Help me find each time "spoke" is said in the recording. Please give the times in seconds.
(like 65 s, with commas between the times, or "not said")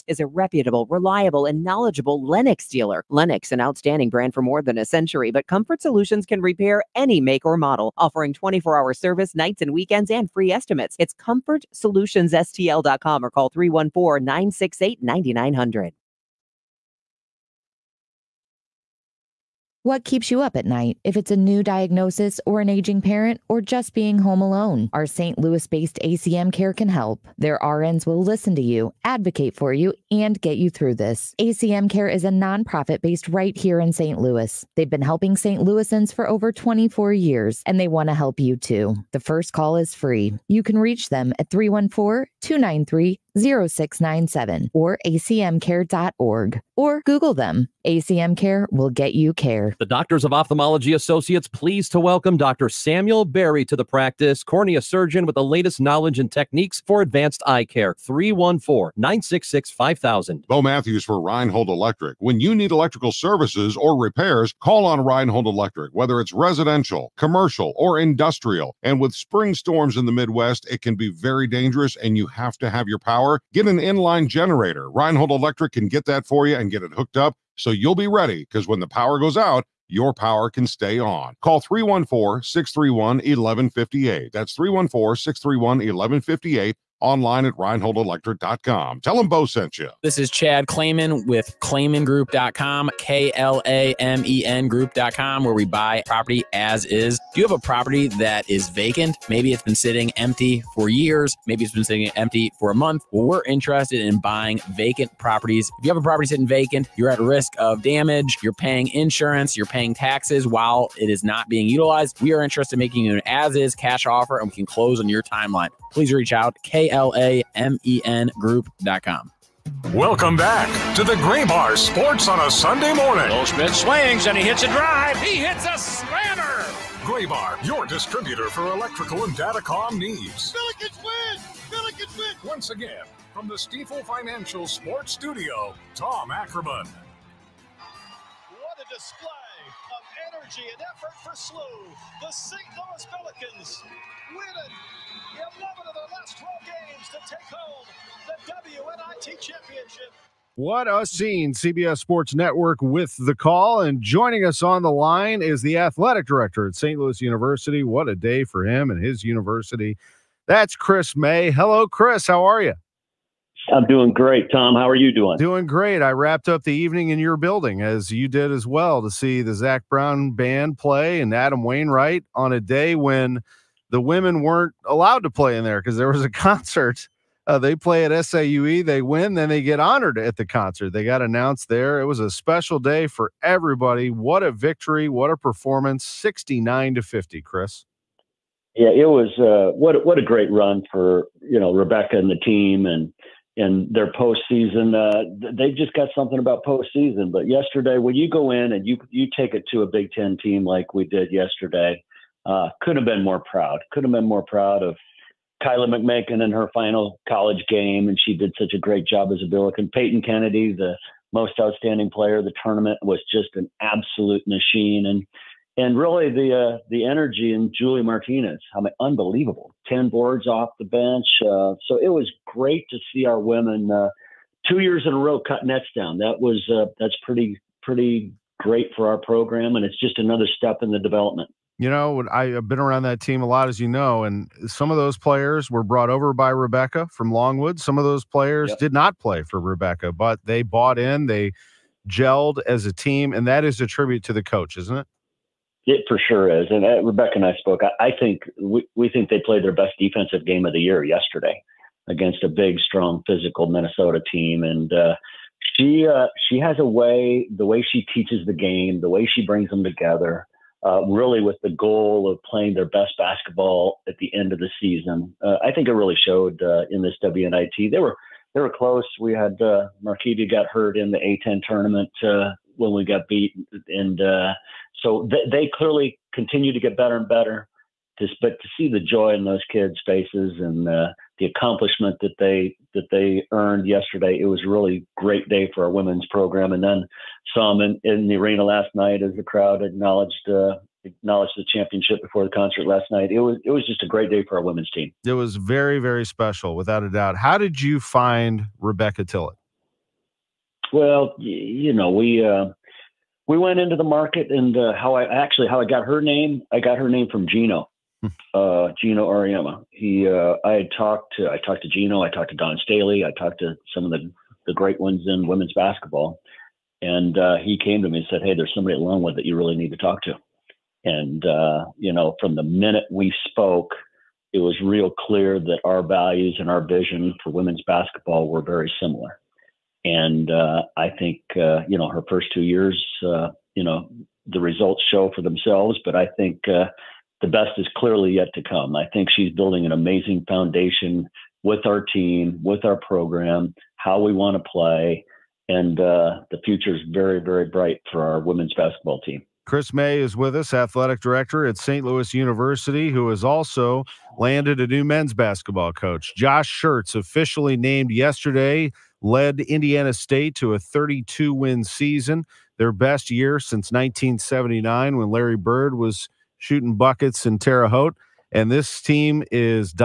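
247 s, 323 s.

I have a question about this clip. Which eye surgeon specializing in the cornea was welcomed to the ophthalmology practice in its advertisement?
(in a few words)
Dr. Samuel Berry.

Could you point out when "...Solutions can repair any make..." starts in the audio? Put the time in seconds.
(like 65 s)
5 s.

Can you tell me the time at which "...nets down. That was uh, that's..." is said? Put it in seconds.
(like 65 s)
225 s.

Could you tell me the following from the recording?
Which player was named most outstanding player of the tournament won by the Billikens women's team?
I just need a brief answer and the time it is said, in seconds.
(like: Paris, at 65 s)
Peyton Kennedy, at 209 s.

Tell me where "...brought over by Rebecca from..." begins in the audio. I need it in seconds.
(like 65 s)
235 s.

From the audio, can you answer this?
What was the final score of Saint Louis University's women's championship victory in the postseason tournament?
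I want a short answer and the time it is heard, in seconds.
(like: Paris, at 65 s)
69-50, at 186 s.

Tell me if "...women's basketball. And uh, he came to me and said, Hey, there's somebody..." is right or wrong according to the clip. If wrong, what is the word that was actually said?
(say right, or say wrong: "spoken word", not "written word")
right.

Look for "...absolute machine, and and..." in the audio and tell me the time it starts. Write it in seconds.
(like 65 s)
213 s.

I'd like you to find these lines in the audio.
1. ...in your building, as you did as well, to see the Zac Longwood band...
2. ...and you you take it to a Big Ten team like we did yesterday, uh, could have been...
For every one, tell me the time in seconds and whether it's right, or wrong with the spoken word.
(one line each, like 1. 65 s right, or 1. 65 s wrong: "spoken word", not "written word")
1. 167 s wrong: "Brown", not "Longwood"
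2. 198 s right.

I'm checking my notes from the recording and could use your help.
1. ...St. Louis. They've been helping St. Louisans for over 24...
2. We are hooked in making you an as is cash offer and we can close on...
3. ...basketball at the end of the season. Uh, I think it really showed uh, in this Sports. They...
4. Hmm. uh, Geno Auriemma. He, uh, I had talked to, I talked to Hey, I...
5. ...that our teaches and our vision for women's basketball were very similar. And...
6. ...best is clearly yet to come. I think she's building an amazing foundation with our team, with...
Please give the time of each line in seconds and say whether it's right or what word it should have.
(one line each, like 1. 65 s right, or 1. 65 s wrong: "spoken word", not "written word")
1. 33 s right
2. 112 s wrong: "interested", not "hooked"
3. 263 s wrong: "WNIT", not "Sports"
4. 308 s wrong: "Geno", not "Hey"
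5. 325 s wrong: "values", not "teaches"
6. 337 s right.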